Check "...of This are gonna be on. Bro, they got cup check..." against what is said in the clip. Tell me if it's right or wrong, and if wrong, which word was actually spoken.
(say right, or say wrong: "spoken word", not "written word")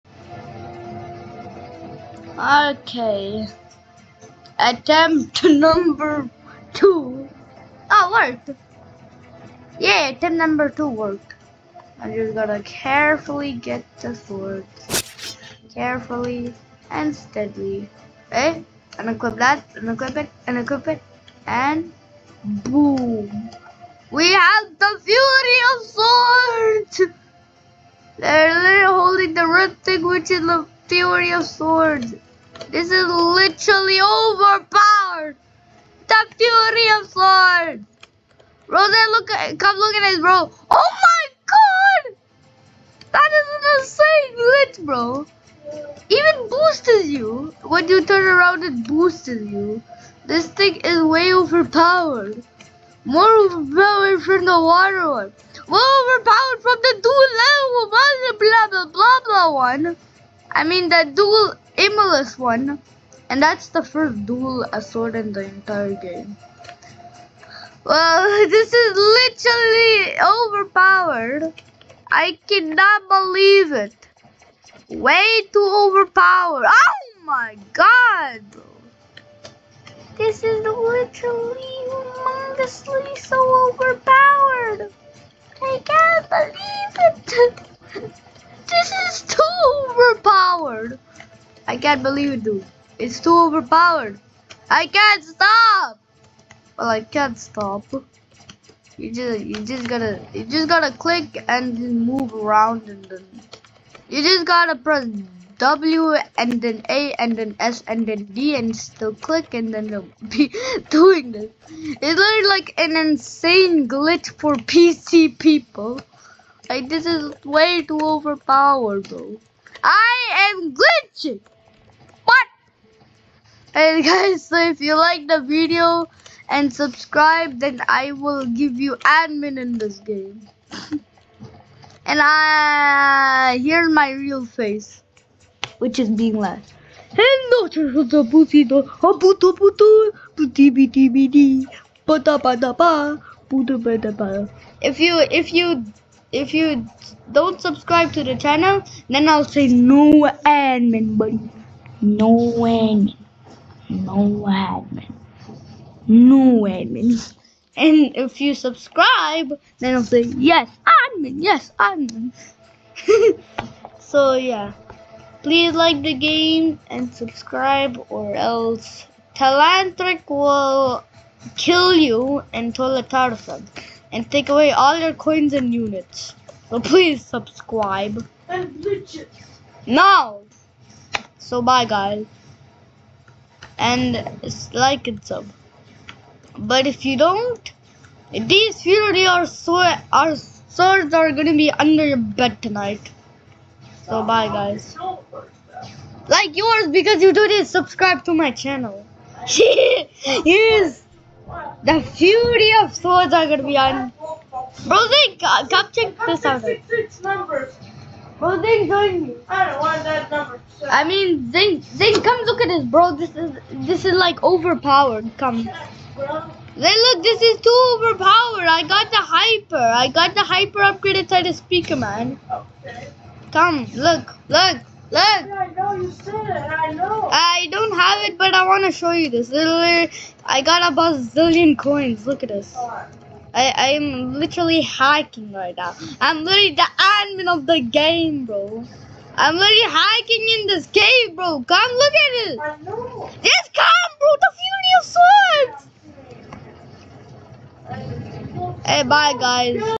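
wrong: "Swords", not "This".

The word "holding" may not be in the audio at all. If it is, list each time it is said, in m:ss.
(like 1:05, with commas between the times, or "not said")
0:28.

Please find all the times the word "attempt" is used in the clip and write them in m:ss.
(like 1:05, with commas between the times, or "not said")
0:04, 0:10.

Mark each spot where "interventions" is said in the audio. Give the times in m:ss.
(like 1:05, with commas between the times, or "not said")
not said.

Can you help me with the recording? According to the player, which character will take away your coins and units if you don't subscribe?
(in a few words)
Talantric.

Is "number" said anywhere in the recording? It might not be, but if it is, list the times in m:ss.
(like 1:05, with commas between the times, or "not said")
0:05, 0:10, 3:30.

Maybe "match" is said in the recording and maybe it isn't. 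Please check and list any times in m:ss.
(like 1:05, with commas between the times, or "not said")
not said.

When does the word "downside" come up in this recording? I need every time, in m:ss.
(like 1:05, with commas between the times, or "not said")
not said.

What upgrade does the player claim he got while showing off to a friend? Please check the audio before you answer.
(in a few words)
hyper upgrade.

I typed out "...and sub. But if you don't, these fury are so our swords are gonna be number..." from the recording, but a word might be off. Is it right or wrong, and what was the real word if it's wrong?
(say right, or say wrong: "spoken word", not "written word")
wrong: "under", not "number".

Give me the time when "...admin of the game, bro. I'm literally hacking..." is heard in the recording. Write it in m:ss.
3:56.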